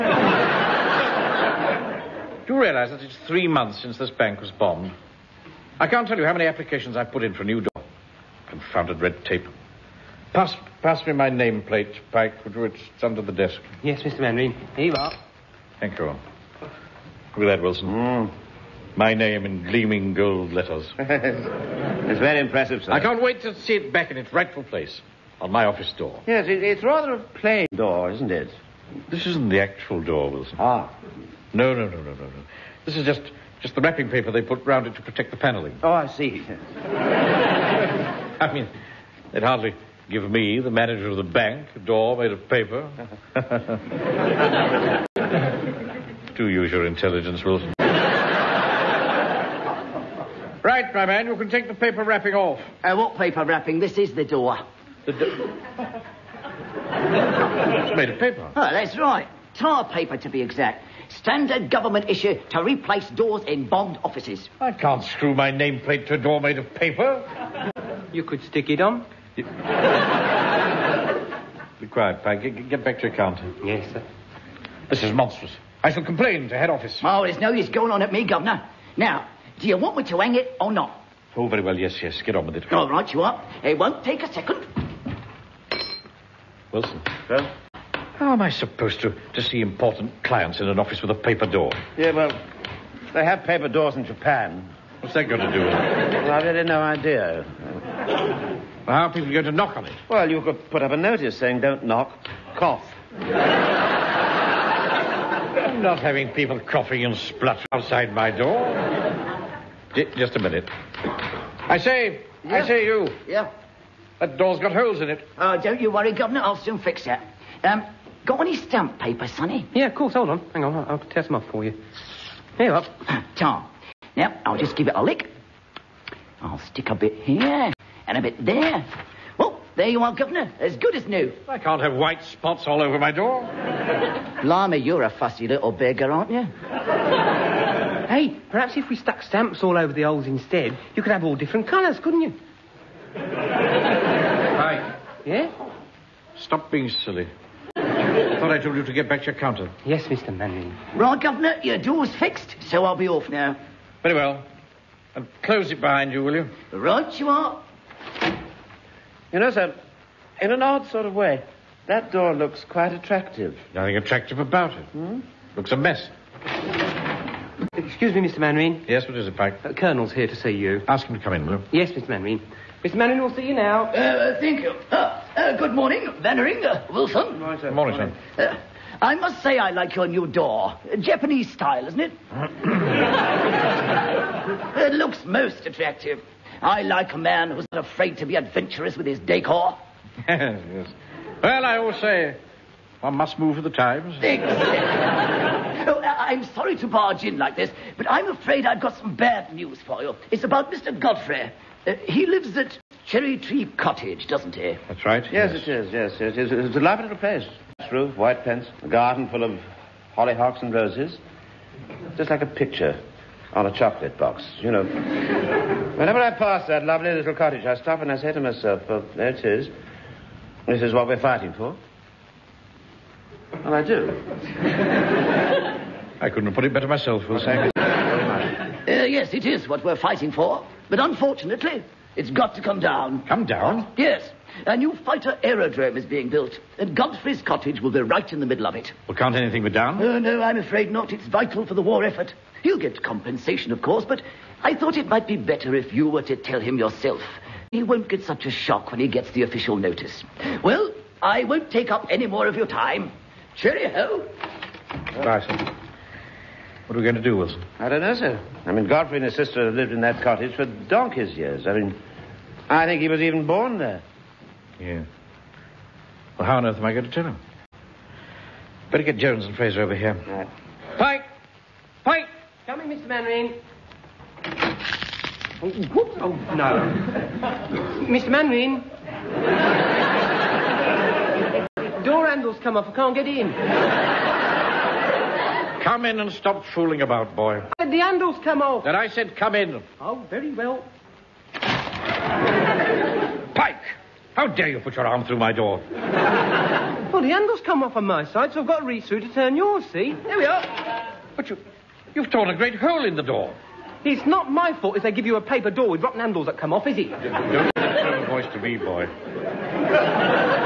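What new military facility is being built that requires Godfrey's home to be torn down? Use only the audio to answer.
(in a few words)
Fighter aerodrome.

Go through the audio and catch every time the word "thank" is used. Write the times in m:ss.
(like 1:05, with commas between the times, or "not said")
0:15, 2:54.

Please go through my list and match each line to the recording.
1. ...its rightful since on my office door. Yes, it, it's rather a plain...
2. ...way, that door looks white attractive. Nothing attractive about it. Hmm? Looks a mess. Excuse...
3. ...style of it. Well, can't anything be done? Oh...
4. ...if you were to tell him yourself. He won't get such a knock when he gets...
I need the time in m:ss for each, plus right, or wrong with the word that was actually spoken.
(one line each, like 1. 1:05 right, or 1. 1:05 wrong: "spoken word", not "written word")
1. 0:24 wrong: "place", not "since"
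2. 2:41 wrong: "quite", not "white"
3. 3:58 wrong: "middle", not "style"
4. 4:05 wrong: "shock", not "knock".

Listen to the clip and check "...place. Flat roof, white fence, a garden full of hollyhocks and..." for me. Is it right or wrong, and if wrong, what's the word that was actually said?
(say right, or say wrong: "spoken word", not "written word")
right.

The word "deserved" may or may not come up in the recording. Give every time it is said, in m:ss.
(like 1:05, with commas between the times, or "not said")
not said.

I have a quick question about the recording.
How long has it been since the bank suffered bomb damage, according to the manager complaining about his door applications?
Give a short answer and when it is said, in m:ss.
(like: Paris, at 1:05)
3 months, at 0:03.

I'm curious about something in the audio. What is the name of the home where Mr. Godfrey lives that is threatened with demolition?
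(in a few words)
Cherry Tree Cottage.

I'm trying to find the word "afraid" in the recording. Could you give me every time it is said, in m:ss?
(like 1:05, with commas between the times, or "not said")
3:07, 3:18, 4:00.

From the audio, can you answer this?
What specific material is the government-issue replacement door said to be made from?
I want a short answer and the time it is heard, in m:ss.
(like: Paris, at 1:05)
Tar paper, at 0:59.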